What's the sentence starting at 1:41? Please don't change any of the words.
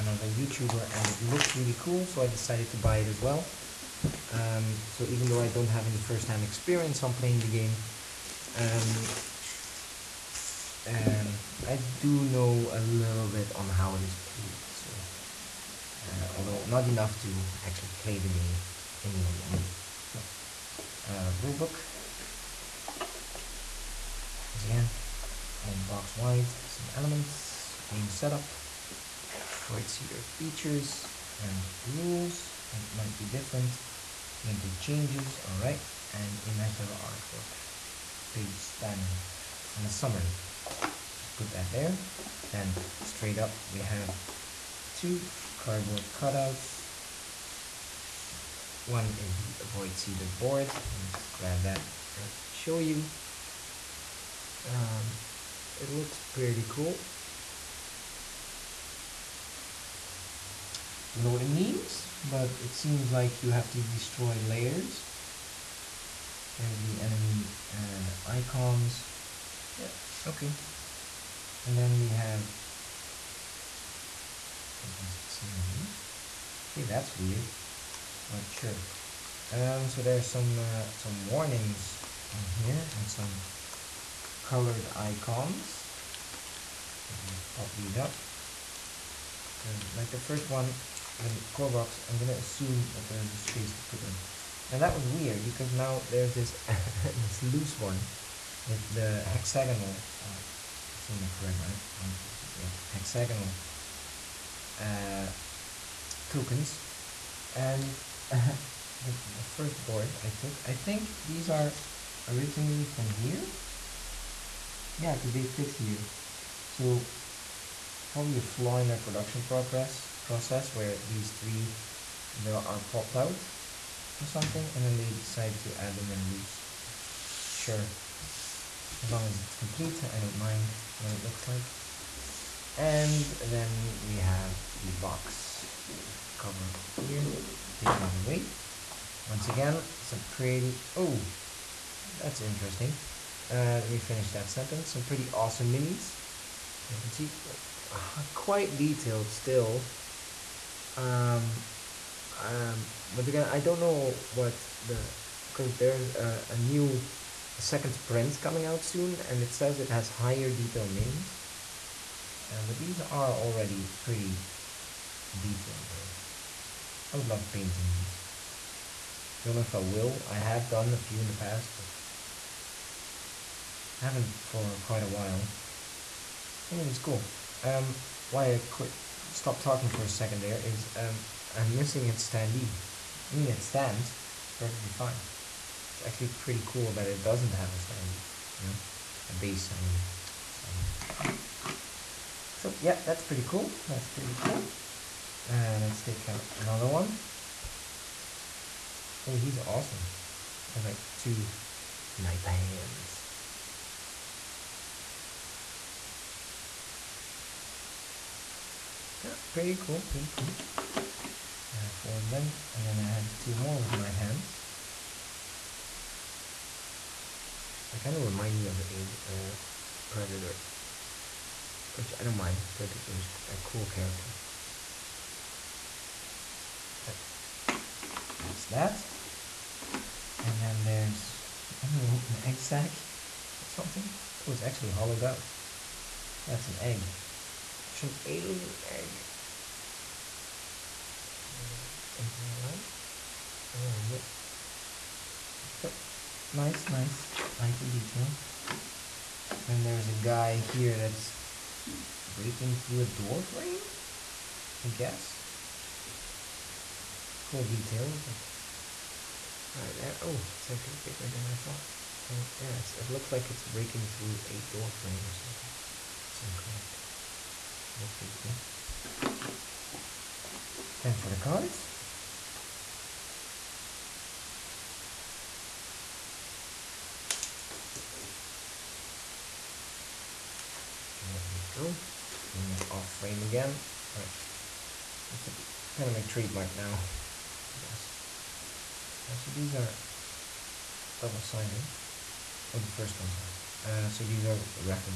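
One, two, three, yeah, hexagonal uh, tokens.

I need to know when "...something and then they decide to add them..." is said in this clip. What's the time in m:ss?
2:04.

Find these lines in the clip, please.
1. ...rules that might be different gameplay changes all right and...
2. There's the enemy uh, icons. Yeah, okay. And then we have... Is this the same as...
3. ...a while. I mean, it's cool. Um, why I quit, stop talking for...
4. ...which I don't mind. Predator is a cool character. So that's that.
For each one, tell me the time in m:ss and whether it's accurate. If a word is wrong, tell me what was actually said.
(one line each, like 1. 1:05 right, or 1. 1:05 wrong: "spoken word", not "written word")
1. 0:31 right
2. 1:06 right
3. 2:55 right
4. 3:41 right.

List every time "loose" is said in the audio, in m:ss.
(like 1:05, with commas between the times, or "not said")
1:37, 2:06.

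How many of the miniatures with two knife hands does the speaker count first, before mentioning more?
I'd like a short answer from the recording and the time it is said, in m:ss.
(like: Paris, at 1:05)
4, at 3:31.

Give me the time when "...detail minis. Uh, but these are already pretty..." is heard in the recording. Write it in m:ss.
2:40.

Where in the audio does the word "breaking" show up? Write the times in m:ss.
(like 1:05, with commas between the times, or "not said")
4:12, 4:23.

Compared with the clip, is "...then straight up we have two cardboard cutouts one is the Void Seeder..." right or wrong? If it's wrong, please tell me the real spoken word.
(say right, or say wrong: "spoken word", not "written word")
right.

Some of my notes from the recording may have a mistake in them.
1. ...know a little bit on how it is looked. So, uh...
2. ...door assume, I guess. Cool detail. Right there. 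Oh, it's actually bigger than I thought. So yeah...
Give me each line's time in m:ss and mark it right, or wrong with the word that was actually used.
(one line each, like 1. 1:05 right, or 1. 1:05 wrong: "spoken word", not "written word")
1. 0:12 wrong: "played", not "looked"
2. 4:13 wrong: "frame", not "assume".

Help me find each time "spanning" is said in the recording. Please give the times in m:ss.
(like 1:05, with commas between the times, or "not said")
0:38.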